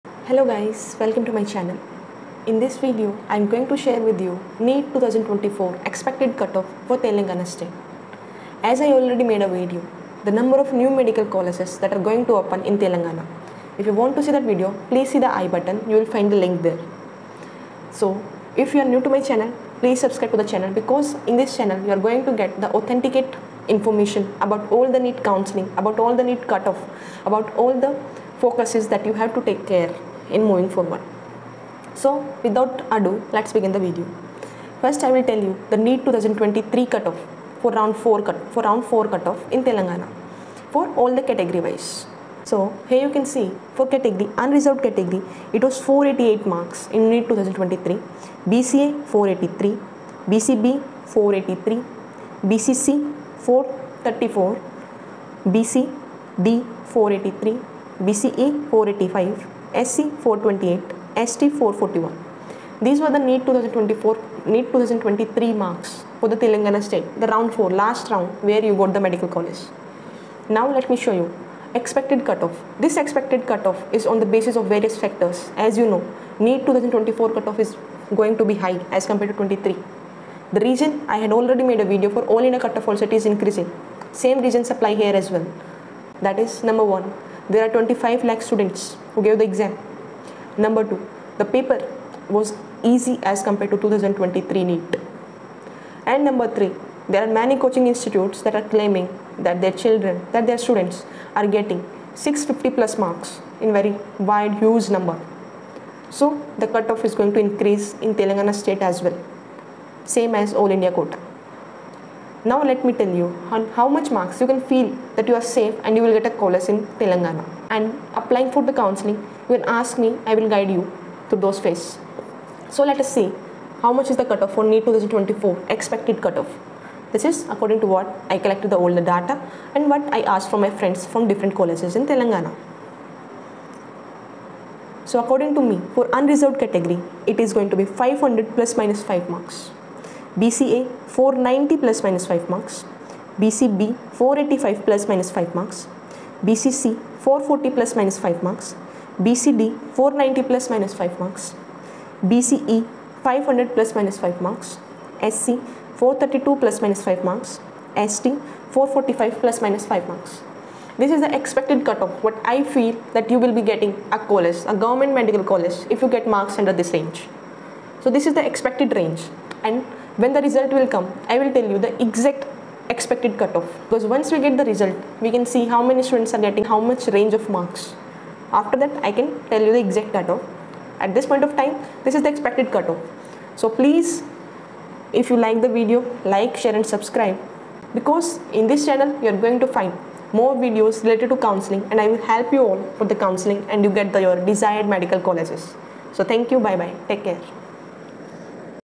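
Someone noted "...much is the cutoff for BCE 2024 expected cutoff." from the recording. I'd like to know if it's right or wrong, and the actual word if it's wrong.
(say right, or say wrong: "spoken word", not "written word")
wrong: "NEET", not "BCE".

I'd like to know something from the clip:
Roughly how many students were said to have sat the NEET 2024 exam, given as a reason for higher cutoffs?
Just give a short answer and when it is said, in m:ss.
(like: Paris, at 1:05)
25 lakh, at 1:27.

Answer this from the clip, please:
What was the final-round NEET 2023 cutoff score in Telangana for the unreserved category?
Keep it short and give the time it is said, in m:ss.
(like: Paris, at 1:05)
488, at 0:45.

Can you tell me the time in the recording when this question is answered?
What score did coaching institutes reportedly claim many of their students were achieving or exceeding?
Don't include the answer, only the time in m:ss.
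1:42.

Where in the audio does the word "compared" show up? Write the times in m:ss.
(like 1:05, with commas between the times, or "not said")
1:19, 1:33.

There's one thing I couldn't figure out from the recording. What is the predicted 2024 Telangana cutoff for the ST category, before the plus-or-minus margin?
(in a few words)
445.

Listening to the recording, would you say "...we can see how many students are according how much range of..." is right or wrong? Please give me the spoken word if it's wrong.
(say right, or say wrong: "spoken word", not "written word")
wrong: "getting", not "according".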